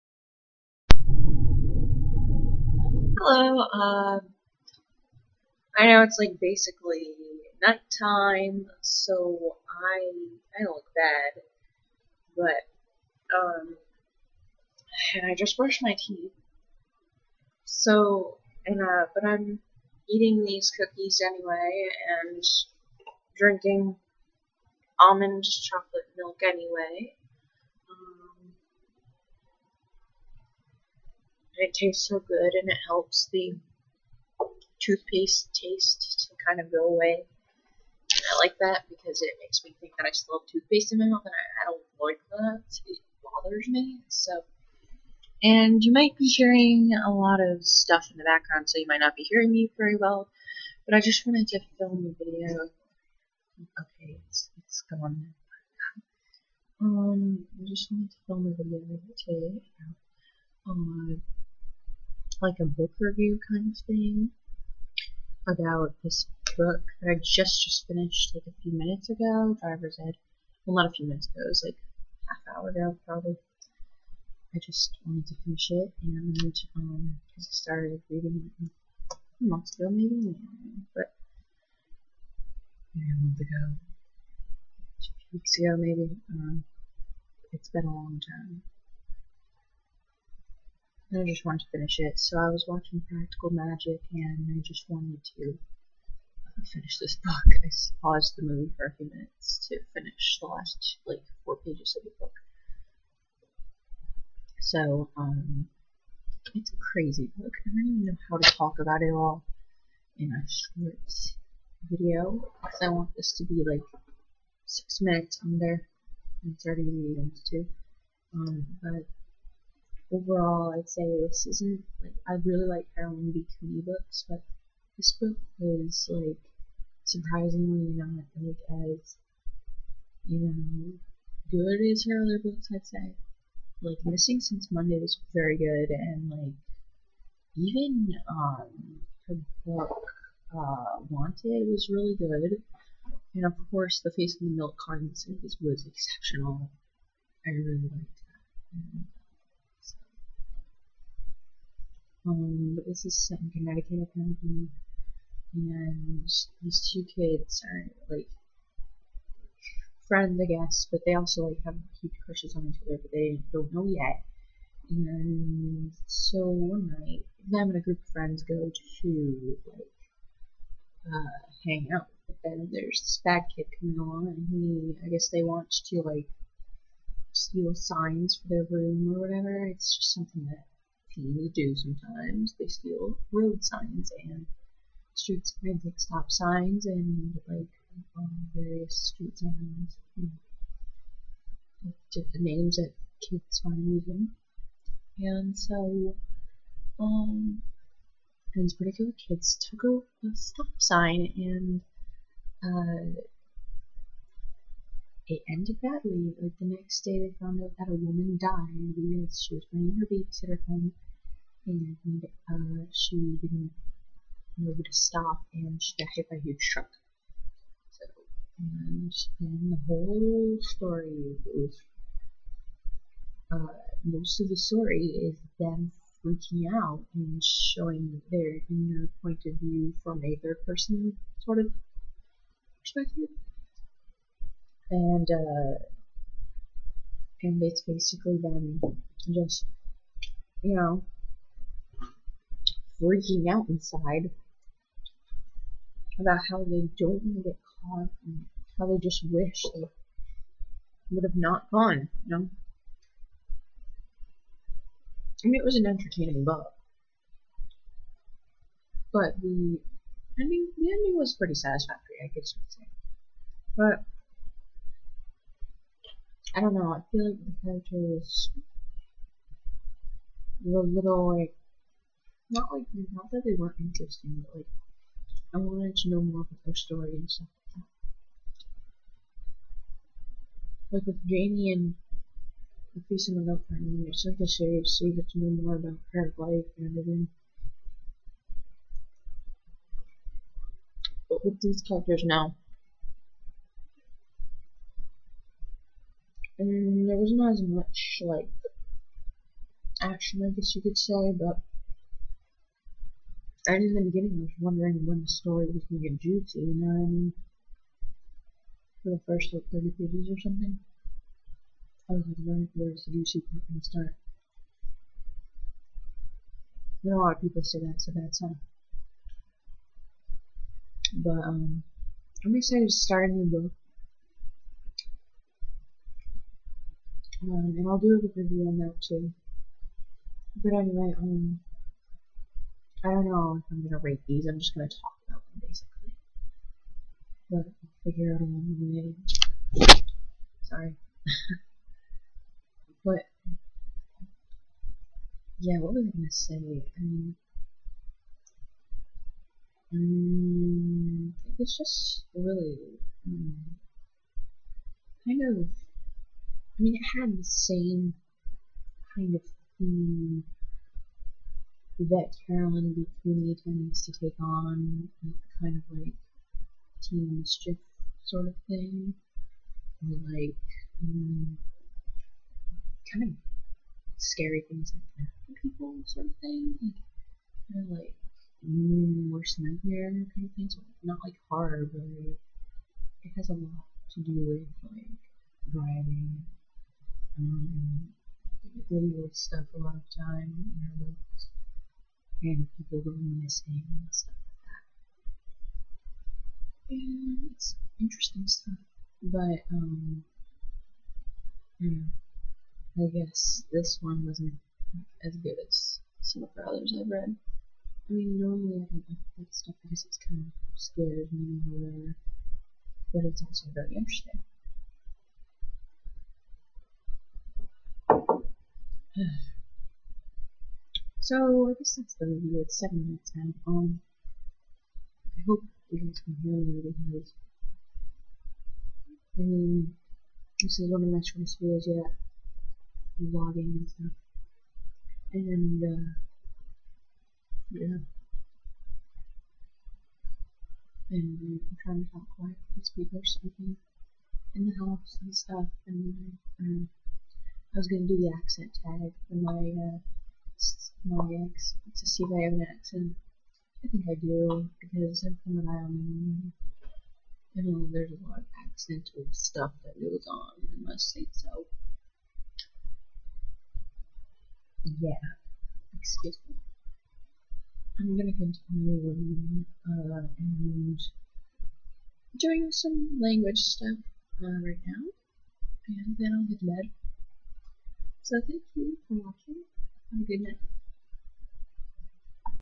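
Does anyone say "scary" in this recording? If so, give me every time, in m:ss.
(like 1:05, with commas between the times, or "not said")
6:14, 6:50.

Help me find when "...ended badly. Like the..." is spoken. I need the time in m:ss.
3:25.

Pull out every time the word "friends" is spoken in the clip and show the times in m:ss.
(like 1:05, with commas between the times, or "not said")
2:40, 2:48.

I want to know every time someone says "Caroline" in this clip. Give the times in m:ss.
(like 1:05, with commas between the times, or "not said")
2:02, 6:02.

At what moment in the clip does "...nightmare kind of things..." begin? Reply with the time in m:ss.
6:19.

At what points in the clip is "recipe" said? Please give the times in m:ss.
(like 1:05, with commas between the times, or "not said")
not said.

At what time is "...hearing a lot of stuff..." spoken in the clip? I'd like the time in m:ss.
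0:46.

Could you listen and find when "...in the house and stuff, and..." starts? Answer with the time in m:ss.
7:24.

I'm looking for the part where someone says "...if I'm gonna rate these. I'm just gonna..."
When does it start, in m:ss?
5:33.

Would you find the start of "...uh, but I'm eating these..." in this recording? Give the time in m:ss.
0:18.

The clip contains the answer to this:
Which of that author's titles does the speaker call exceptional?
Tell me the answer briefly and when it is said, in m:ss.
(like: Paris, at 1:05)
The Face in the Milk Carton, at 2:24.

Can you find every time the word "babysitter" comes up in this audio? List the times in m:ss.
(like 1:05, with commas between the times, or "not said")
3:30.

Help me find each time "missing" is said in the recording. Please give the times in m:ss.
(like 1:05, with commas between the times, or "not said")
2:14, 6:33.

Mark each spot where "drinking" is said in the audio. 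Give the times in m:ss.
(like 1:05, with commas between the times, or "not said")
0:23.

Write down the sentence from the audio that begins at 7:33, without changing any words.
I think I do, because I'm from an island.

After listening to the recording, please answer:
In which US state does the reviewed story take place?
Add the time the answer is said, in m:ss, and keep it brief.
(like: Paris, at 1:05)
Connecticut, at 2:33.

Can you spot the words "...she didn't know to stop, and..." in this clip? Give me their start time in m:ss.
3:32.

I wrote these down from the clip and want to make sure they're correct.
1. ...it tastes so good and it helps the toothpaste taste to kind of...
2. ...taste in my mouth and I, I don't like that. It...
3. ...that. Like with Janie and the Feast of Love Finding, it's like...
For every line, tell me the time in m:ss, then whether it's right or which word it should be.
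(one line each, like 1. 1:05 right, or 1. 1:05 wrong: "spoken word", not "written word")
1. 0:31 right
2. 0:40 wrong: "toothpaste", not "taste"
3. 4:40 right.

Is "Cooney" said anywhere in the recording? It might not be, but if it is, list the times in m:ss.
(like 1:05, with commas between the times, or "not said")
2:03, 6:03.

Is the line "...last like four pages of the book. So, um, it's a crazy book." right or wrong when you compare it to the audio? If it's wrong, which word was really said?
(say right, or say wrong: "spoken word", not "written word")
right.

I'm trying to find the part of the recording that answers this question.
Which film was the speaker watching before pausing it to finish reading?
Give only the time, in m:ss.
1:33.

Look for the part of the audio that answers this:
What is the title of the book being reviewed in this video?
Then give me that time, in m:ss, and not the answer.
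1:09.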